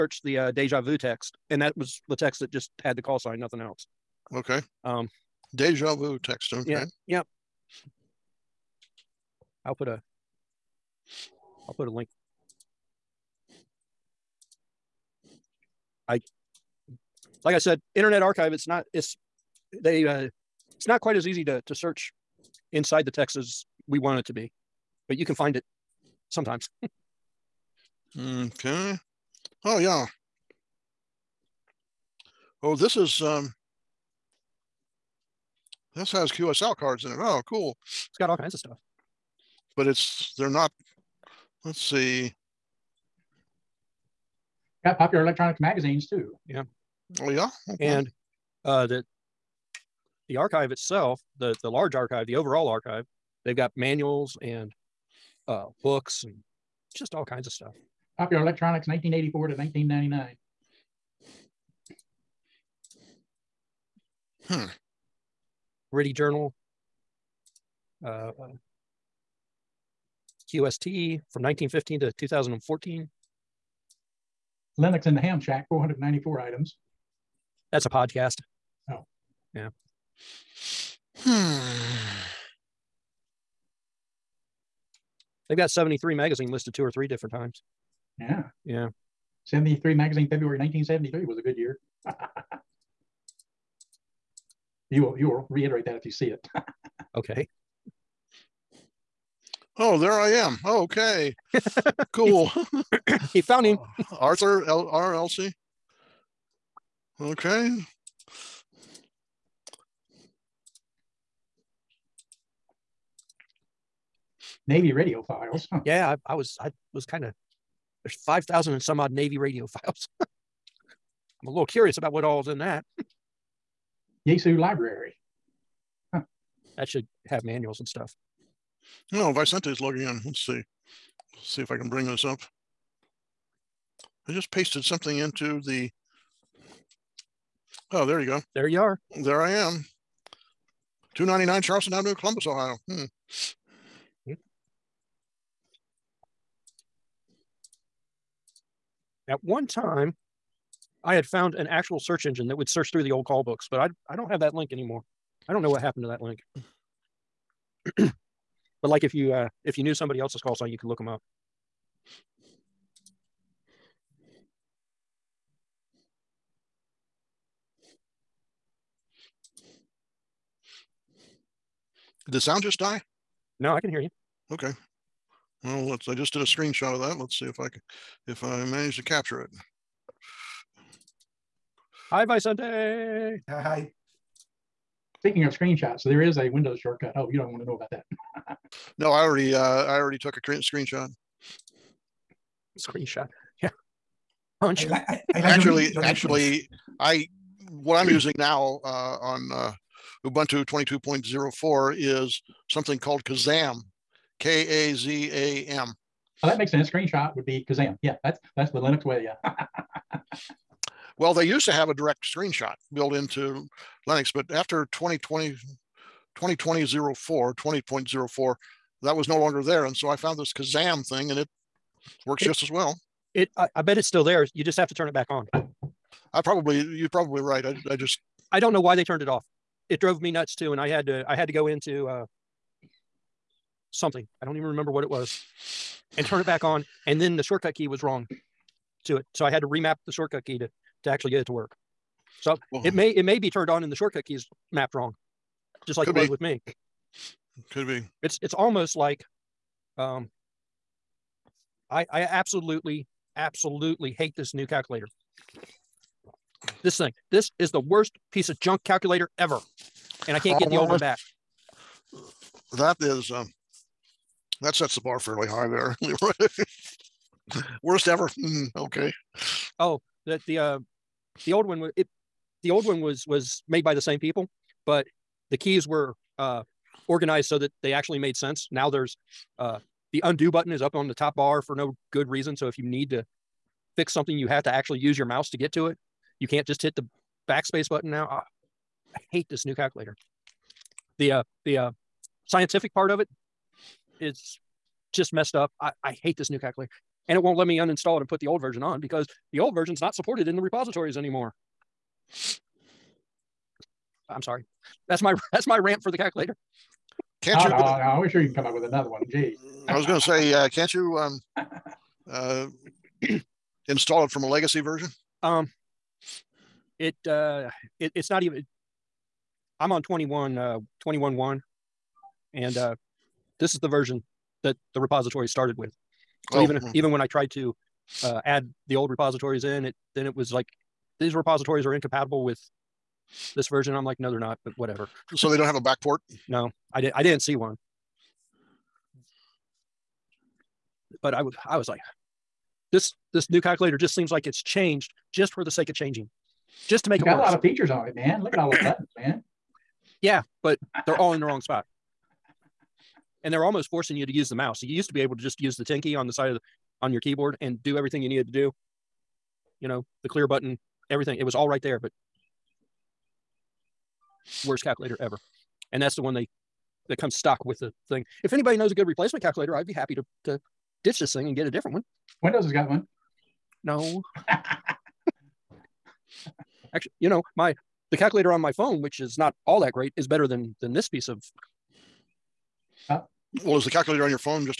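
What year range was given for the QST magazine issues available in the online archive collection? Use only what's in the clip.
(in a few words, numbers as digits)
1915 to 2014.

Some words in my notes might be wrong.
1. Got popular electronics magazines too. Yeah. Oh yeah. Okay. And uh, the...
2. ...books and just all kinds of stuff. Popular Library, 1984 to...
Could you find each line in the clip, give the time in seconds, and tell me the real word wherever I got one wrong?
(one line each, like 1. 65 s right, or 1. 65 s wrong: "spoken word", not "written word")
1. 44 s right
2. 55 s wrong: "Electronics", not "Library".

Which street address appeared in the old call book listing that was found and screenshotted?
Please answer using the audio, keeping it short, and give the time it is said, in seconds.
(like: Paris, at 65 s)
299 Charleston Avenue, at 141 s.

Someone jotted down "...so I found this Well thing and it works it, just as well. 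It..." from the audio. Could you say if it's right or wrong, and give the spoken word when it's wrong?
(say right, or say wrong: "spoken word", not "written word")
wrong: "Kazam", not "Well".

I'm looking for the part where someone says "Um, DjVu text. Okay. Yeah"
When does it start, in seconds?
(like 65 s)
4 s.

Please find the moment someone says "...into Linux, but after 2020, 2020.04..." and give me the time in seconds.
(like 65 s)
213 s.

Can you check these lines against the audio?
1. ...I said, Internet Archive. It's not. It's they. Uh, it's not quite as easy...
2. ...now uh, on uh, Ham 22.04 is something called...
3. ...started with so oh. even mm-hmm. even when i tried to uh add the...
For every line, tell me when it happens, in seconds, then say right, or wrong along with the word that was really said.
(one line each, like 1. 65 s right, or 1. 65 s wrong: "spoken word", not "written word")
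1. 17 s right
2. 198 s wrong: "Ubuntu", not "Ham"
3. 325 s right.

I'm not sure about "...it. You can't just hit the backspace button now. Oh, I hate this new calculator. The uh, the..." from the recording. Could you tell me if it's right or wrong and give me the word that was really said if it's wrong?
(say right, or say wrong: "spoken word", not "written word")
right.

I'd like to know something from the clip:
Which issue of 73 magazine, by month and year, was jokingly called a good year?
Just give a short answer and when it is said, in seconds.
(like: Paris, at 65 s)
February 1973, at 90 s.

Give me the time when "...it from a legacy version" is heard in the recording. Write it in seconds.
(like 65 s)
314 s.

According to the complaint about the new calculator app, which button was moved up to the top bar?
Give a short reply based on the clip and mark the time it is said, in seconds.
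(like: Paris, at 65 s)
undo button, at 280 s.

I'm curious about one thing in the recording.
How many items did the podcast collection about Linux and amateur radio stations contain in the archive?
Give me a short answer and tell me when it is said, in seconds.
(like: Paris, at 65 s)
494, at 75 s.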